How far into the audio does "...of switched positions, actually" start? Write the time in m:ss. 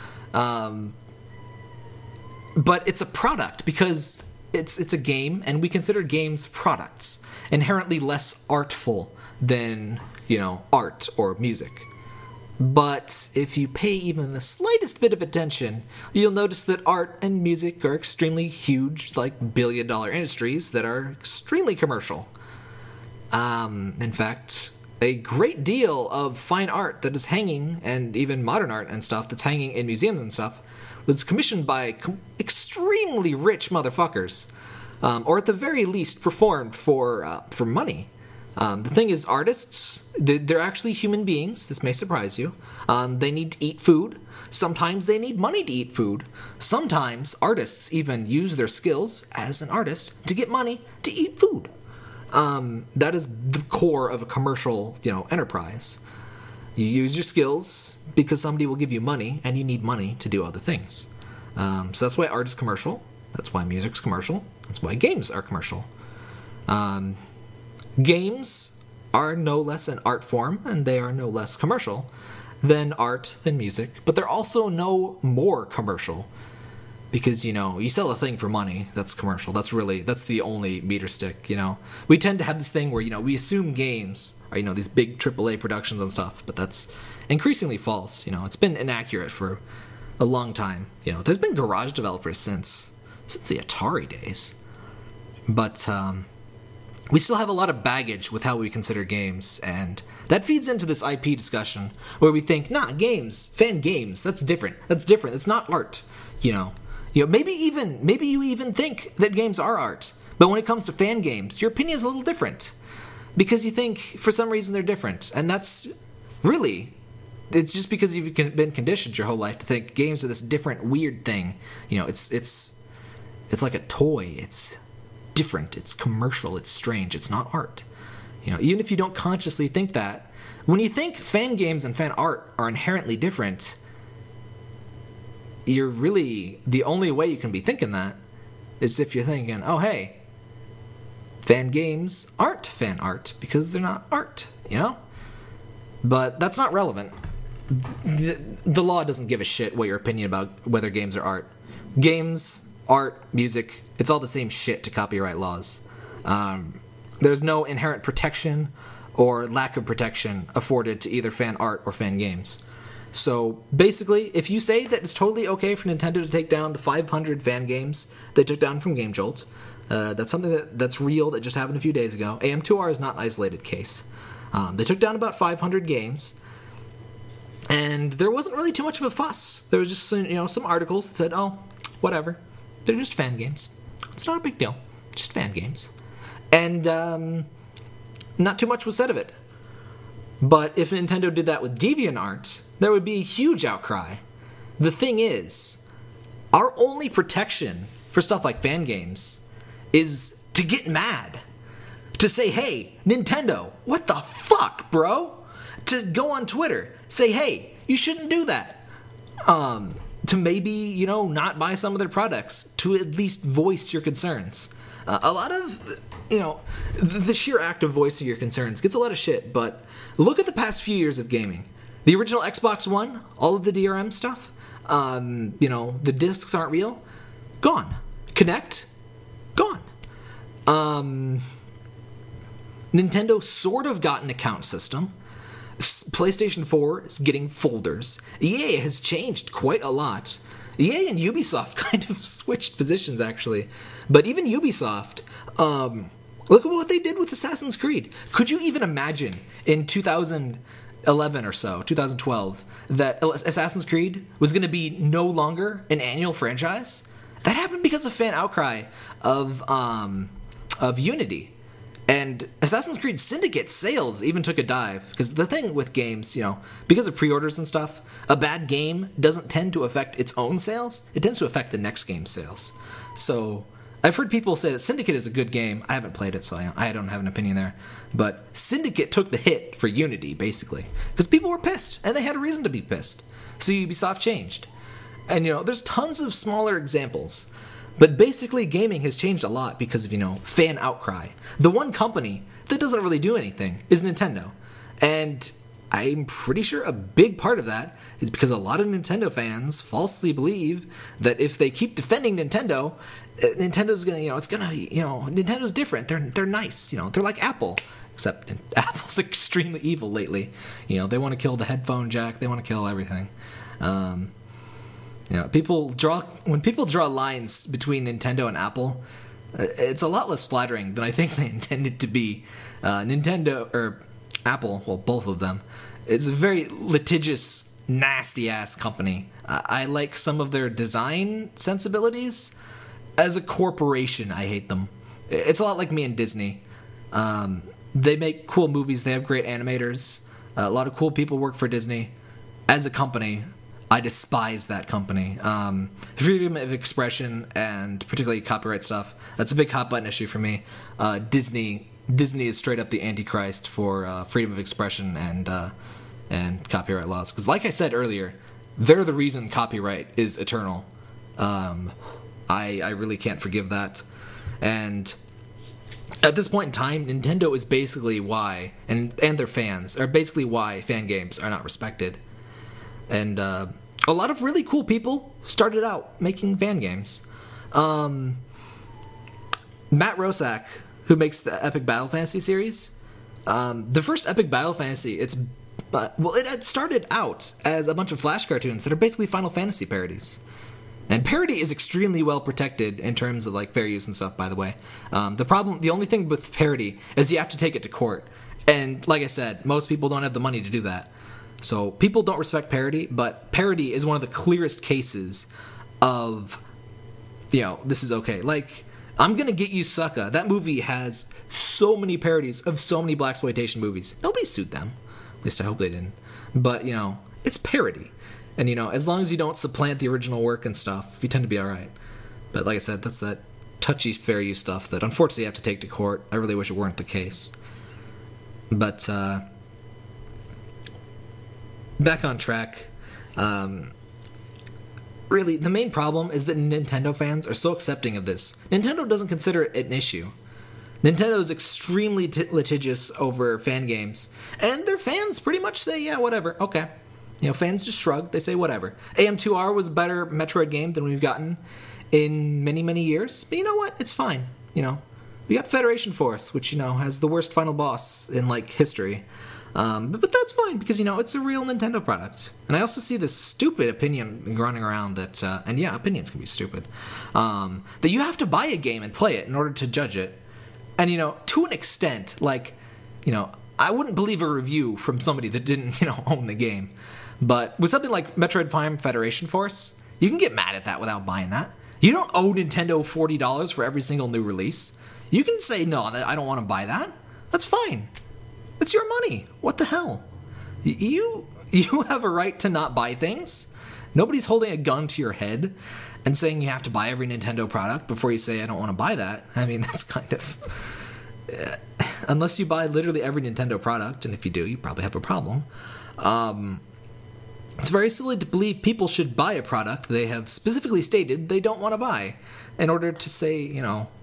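4:02.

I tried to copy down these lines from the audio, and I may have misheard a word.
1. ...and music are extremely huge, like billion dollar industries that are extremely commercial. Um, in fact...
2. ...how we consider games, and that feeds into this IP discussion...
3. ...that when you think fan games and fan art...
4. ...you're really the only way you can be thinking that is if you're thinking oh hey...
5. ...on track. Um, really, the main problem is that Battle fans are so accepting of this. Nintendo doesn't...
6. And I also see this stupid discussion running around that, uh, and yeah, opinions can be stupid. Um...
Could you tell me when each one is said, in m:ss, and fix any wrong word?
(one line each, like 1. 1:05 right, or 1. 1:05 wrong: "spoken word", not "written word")
1. 0:17 right
2. 1:38 right
3. 2:09 right
4. 2:15 right
5. 7:12 wrong: "Nintendo", not "Battle"
6. 7:42 wrong: "opinion", not "discussion".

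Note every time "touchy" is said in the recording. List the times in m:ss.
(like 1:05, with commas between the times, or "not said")
7:03.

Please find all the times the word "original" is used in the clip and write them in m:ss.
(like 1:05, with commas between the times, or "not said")
3:42, 7:00.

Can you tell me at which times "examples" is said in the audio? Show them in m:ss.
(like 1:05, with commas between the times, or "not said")
4:46.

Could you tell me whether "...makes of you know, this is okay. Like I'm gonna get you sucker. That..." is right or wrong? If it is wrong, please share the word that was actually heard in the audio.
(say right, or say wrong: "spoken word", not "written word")
wrong: "cases", not "makes".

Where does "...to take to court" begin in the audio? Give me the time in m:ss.
7:05.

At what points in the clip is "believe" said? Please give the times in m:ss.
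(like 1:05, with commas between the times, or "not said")
5:00, 7:54, 8:28.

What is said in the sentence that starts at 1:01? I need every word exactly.
Um, so that's why art is commercial.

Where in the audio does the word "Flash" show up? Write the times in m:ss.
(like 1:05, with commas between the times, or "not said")
6:28.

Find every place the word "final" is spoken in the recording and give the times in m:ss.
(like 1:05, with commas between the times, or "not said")
6:29, 7:37.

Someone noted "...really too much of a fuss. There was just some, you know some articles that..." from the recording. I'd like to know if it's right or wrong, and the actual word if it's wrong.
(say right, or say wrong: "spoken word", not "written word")
right.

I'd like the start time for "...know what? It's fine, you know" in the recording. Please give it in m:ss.
7:33.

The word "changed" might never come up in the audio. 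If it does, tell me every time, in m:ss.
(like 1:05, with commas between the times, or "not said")
3:59, 4:44, 4:49.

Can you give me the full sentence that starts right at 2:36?
Um, there's no inherent protection or lack of protection afforded to either fan art or fan games.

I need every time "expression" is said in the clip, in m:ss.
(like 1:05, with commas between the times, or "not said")
5:46, 5:54.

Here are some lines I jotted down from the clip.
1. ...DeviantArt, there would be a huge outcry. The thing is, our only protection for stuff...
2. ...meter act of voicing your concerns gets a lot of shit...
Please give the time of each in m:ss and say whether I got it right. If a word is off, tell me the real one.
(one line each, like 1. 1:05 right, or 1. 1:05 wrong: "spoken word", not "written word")
1. 3:11 right
2. 3:37 wrong: "sheer", not "meter".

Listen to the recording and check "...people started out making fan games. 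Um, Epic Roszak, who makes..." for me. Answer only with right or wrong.
wrong.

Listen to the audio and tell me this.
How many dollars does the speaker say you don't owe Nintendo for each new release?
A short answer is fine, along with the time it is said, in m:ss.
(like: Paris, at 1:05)
40, at 8:03.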